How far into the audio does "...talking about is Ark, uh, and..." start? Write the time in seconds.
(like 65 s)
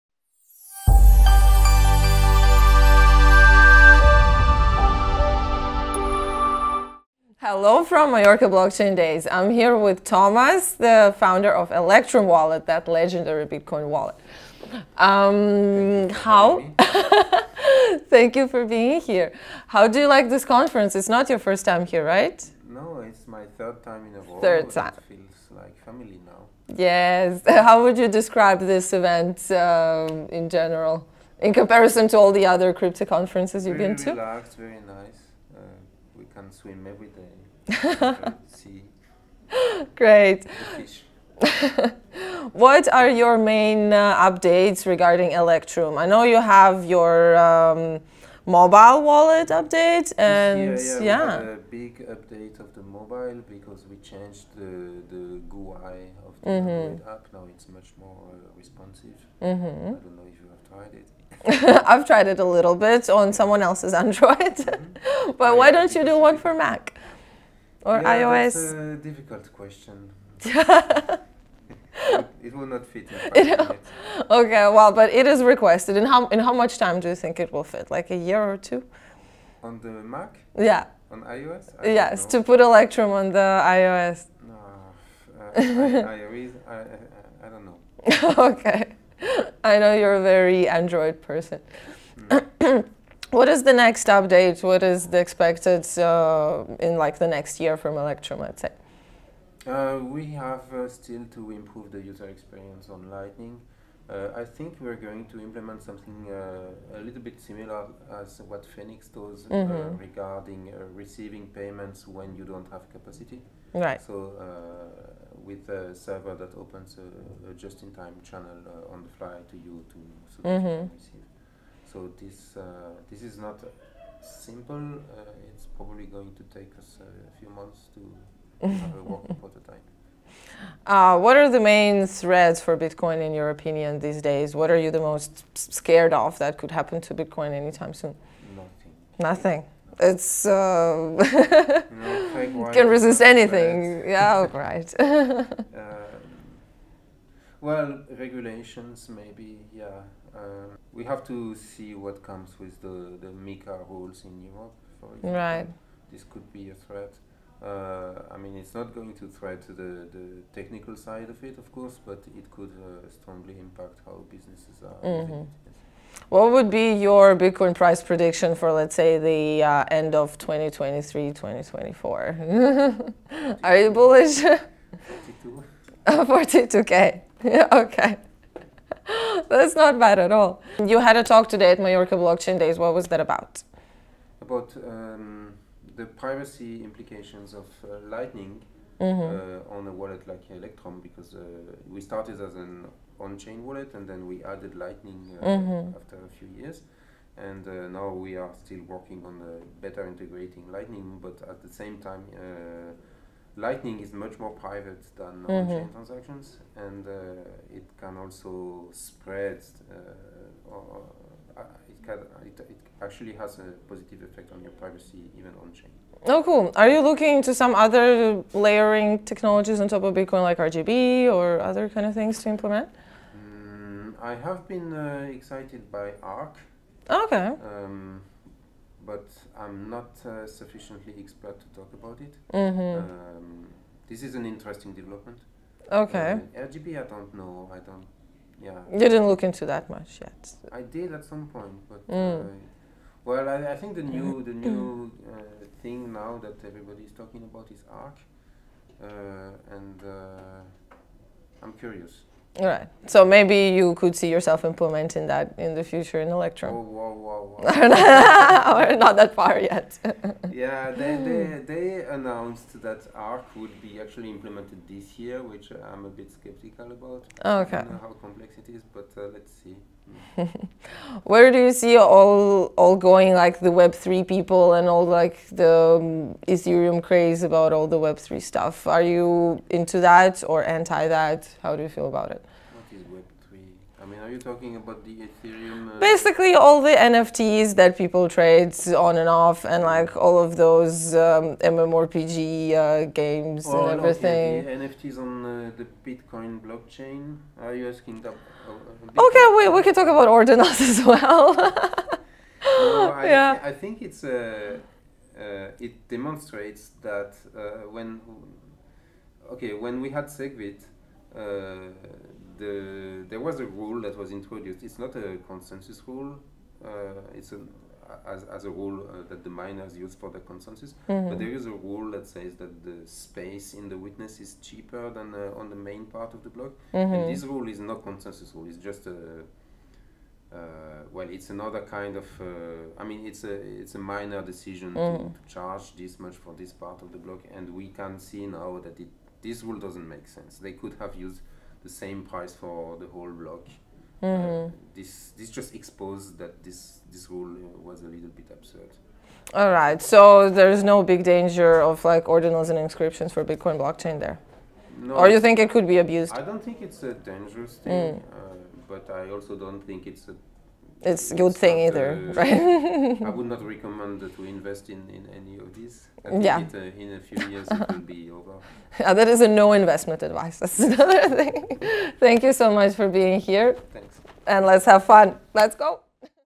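247 s.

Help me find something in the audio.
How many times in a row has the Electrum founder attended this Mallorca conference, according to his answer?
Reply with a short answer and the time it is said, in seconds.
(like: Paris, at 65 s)
3, at 23 s.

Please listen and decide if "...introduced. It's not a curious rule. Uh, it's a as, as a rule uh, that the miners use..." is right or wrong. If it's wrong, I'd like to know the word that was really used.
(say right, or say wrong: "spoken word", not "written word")
wrong: "consensus", not "curious".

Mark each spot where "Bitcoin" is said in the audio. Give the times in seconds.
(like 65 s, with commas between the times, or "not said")
13 s, 132 s, 137 s, 167 s, 220 s, 296 s, 353 s.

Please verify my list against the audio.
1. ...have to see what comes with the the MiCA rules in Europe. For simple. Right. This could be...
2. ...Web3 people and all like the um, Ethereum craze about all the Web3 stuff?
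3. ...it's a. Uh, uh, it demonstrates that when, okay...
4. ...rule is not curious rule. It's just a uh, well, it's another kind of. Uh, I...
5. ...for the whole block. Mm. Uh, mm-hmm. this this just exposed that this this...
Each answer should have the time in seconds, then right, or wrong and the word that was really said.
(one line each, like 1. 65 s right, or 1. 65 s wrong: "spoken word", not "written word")
1. 151 s wrong: "example", not "simple"
2. 273 s right
3. 304 s right
4. 327 s wrong: "consensus", not "curious"
5. 342 s right.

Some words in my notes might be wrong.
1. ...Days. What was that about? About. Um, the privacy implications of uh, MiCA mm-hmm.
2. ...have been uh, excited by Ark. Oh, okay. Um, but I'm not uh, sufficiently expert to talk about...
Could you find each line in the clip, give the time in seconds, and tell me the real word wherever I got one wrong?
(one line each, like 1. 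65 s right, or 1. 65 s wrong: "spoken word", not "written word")
1. 182 s wrong: "Lightning", not "MiCA"
2. 224 s right.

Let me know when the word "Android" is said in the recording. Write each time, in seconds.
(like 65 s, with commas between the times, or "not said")
64 s, 90 s.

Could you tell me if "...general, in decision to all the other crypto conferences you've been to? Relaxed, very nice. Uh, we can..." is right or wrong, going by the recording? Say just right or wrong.
wrong.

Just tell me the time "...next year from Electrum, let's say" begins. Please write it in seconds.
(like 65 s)
97 s.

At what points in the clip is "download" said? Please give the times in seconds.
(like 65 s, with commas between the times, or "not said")
not said.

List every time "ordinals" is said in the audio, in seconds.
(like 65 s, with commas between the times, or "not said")
300 s, 352 s.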